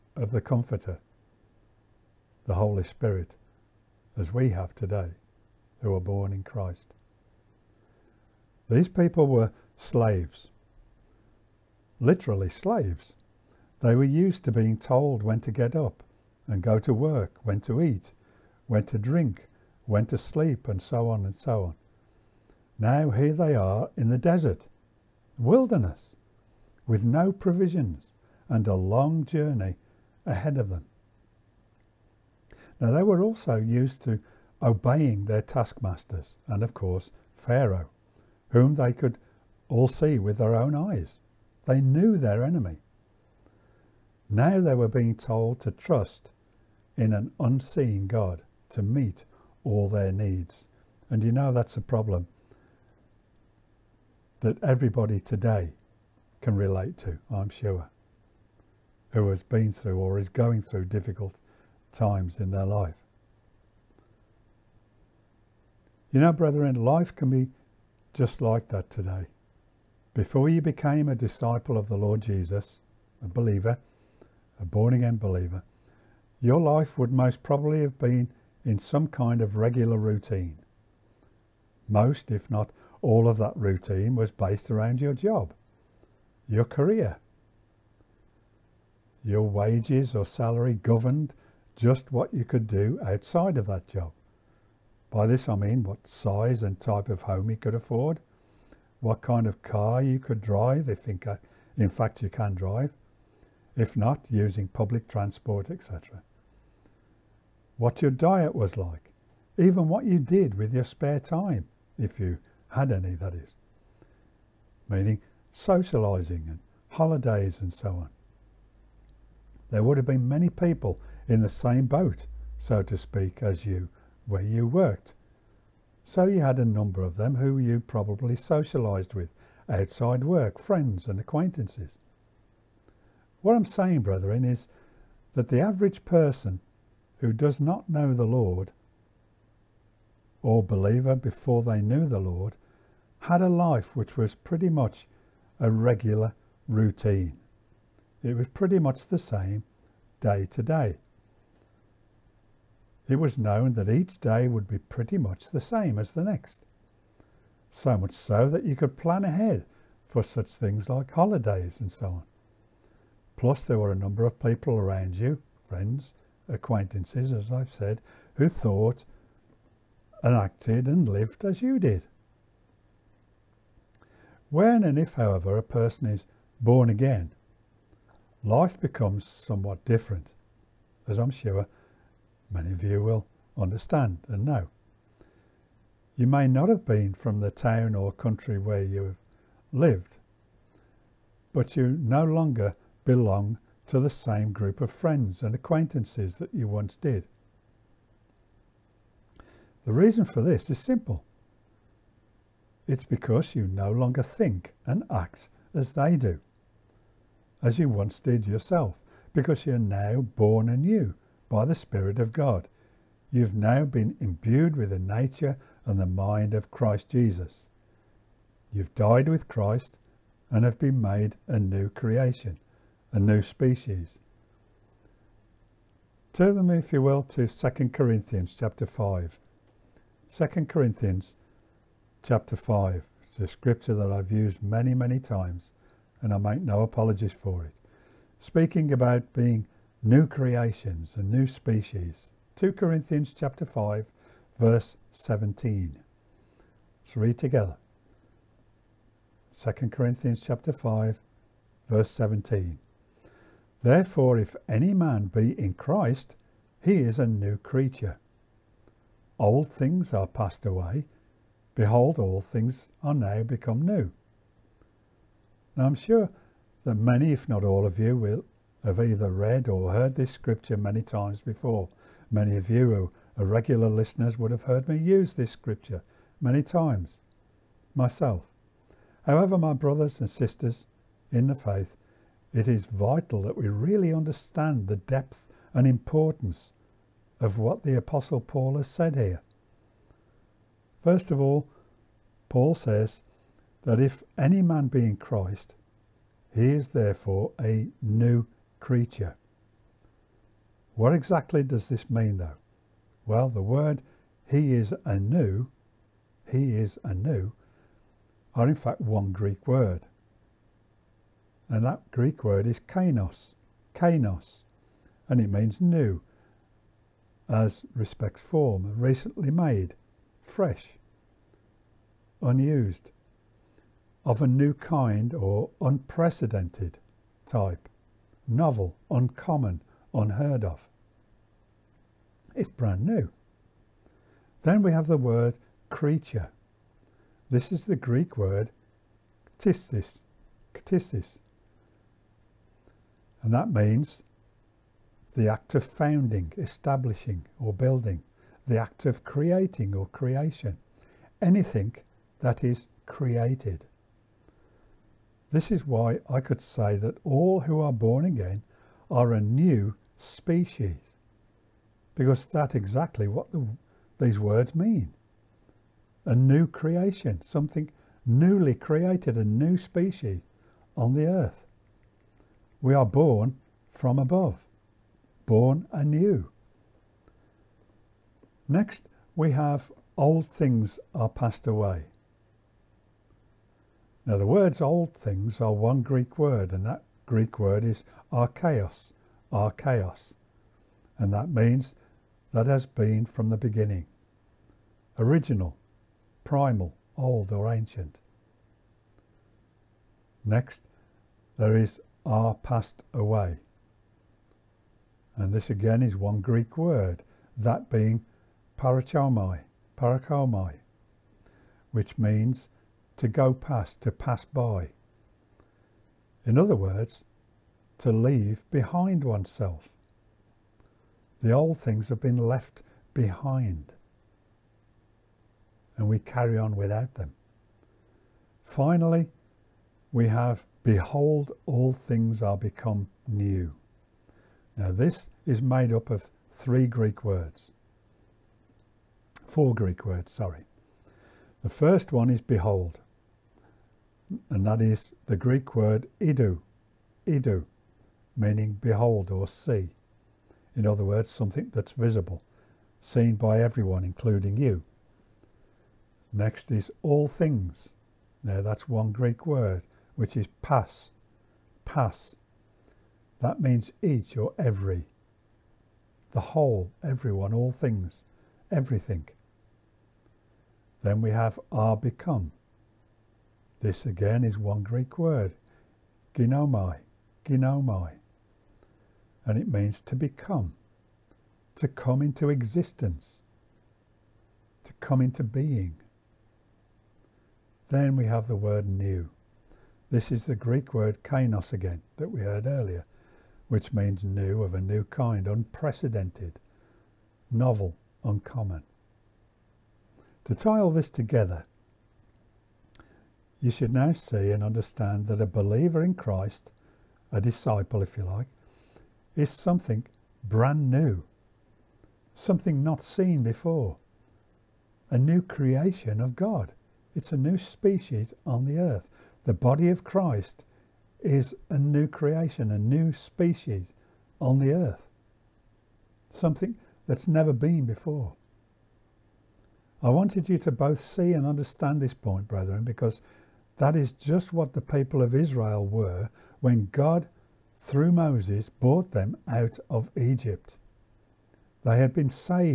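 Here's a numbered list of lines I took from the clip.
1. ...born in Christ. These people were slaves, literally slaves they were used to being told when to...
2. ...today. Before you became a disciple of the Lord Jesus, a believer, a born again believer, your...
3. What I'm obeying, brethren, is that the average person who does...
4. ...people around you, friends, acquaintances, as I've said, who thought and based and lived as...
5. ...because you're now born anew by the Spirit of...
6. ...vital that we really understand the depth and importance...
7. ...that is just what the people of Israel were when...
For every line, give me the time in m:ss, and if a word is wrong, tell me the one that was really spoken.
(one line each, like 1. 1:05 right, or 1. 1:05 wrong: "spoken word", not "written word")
1. 0:05 right
2. 1:08 right
3. 2:13 wrong: "saying", not "obeying"
4. 2:44 wrong: "acted", not "based"
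5. 3:29 right
6. 4:42 right
7. 8:53 right.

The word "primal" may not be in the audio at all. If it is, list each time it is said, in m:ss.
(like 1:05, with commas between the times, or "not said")
6:36.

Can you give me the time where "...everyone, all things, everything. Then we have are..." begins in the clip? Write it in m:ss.
7:47.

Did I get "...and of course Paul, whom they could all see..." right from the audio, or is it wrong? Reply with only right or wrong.
wrong.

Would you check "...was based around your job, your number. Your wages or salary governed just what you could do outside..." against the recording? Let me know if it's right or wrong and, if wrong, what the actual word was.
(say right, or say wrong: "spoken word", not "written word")
wrong: "career", not "number".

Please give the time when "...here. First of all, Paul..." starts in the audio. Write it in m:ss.
4:49.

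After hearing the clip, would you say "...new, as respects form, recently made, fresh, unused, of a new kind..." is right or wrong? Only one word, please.
right.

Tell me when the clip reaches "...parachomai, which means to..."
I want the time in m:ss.
6:49.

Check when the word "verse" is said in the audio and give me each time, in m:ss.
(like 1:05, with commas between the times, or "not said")
4:04, 4:11.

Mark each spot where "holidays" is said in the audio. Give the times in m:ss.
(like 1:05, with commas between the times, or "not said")
1:56, 2:41.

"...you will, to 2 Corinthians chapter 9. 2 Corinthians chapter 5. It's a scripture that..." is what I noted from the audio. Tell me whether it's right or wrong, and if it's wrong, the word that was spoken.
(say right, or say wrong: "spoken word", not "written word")
wrong: "5", not "9".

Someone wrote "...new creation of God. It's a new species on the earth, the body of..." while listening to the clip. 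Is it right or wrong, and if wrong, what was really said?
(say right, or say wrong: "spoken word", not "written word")
right.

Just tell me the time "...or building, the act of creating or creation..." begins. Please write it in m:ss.
5:47.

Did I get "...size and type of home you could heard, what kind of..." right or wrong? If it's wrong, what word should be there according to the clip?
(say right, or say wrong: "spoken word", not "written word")
wrong: "afford", not "heard".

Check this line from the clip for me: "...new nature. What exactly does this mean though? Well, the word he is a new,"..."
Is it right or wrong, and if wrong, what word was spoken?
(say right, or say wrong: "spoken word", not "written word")
wrong: "creature", not "nature".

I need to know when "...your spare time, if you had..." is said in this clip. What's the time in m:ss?
1:50.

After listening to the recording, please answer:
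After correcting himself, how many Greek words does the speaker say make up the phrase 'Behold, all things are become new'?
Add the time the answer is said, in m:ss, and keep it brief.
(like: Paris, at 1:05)
4, at 7:19.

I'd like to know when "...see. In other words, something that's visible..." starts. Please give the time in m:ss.
7:29.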